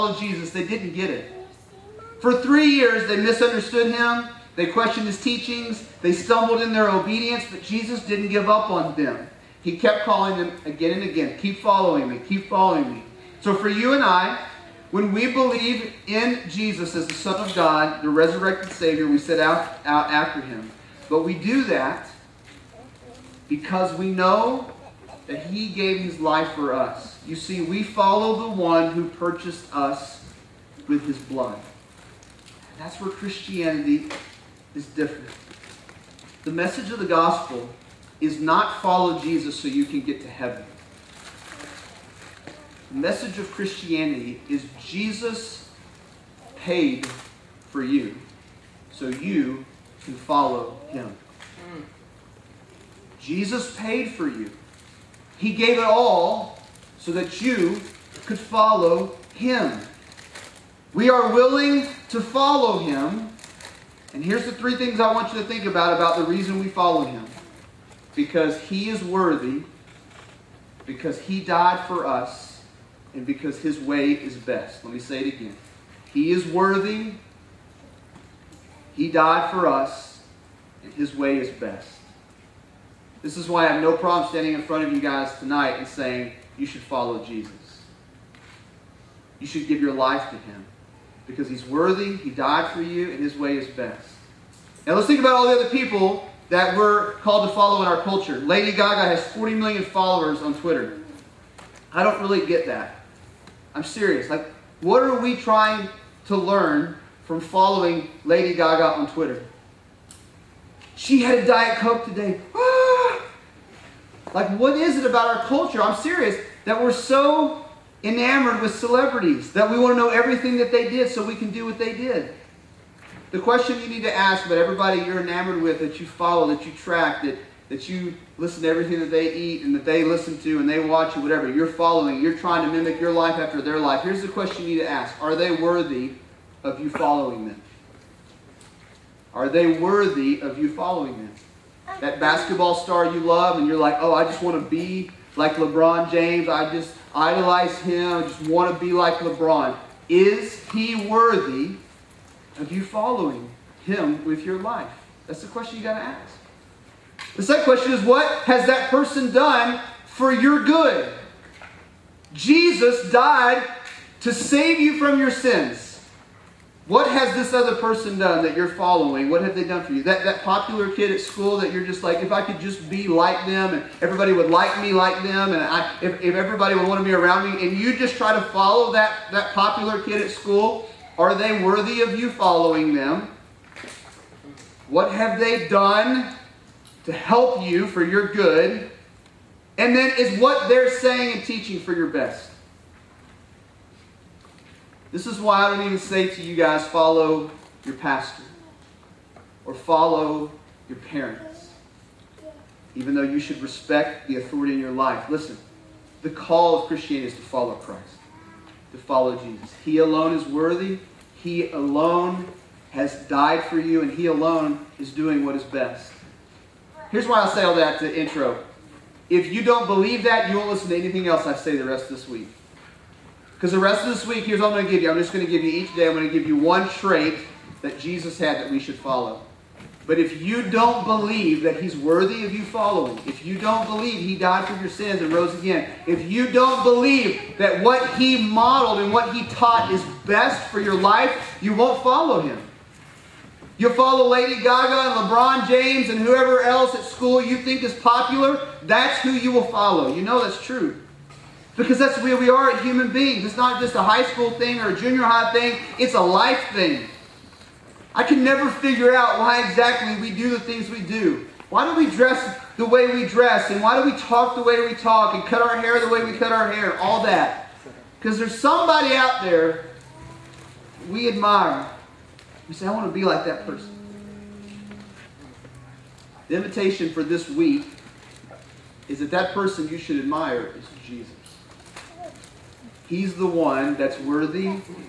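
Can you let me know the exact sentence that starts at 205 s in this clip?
Listen, the call of Christianity is to follow Christ, to follow Jesus.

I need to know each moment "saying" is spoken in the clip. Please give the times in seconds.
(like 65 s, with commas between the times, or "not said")
85 s, 190 s.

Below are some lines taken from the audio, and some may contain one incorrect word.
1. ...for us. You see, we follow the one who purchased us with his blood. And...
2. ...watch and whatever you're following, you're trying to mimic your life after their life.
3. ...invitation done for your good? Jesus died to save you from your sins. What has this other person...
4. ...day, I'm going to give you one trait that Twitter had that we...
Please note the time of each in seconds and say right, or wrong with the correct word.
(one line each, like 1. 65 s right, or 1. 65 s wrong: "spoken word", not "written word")
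1. 26 s right
2. 130 s right
3. 158 s wrong: "person", not "invitation"
4. 225 s wrong: "Jesus", not "Twitter".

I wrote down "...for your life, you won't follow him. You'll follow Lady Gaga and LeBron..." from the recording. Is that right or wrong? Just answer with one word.
right.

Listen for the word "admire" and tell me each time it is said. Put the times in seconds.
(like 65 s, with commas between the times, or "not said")
271 s, 280 s.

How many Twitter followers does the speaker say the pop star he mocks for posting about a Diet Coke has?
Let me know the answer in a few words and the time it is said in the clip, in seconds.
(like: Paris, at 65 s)
40 million, at 99 s.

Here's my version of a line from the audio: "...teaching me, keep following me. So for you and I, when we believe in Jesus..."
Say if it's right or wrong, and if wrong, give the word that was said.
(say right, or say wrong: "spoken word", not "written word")
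wrong: "following", not "teaching".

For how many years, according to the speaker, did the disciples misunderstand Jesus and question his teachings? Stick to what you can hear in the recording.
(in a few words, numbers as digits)
3.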